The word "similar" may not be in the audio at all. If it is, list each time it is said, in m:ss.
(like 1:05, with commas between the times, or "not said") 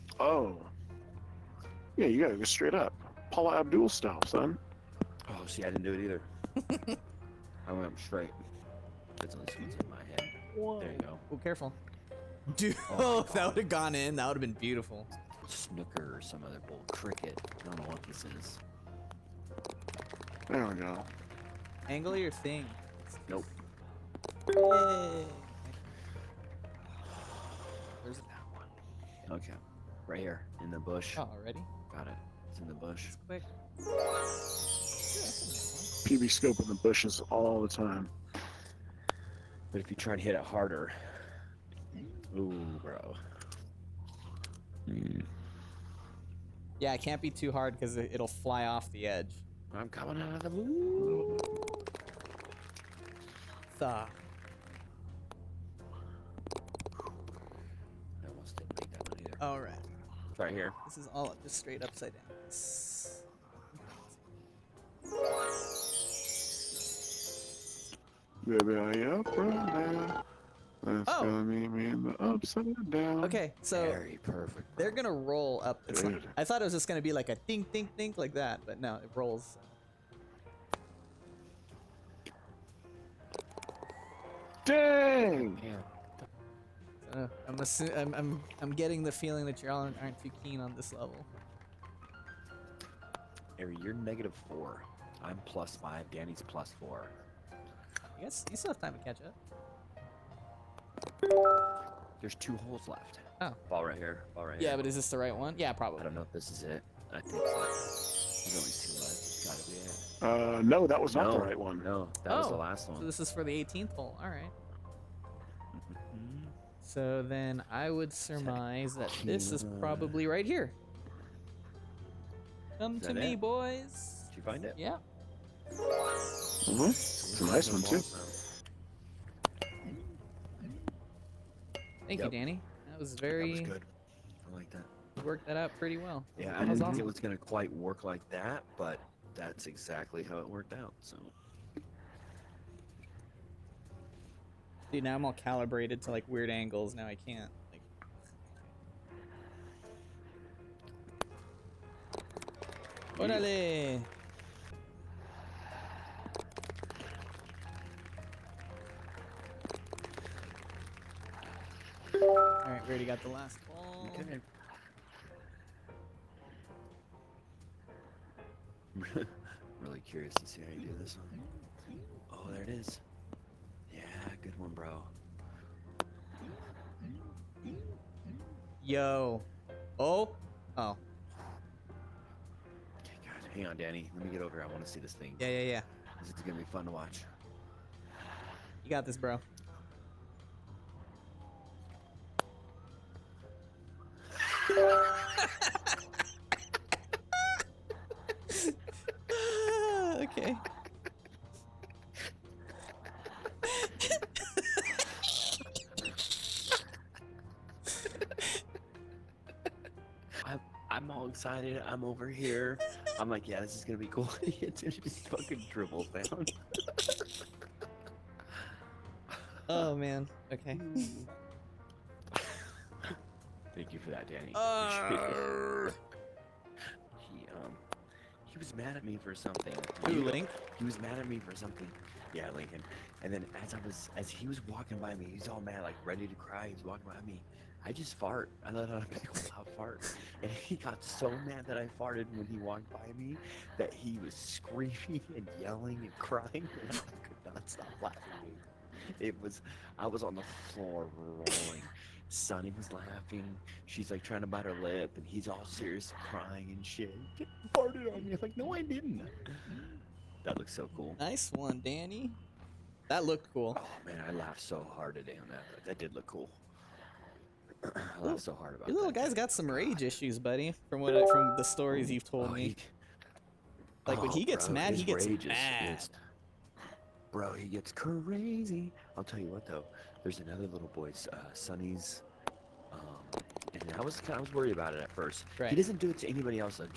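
not said.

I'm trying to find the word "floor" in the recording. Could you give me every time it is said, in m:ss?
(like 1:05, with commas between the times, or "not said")
4:10.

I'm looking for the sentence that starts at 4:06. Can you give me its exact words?
And I could not stop laughing.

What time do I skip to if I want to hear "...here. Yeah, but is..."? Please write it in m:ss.
1:44.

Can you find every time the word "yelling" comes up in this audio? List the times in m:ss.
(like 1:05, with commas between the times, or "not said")
4:05.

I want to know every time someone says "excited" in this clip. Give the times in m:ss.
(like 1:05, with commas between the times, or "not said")
3:31.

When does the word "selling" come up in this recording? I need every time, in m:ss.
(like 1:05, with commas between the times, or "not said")
not said.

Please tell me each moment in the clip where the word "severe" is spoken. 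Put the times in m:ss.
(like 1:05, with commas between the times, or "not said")
not said.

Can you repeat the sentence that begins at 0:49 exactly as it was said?
I'm coming out of the moon.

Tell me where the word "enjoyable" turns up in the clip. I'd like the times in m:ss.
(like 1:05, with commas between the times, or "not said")
not said.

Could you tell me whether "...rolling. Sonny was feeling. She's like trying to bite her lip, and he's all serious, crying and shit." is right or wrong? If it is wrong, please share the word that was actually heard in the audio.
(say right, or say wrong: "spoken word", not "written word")
wrong: "laughing", not "feeling".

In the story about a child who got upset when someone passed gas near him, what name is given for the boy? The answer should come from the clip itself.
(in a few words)
Lincoln.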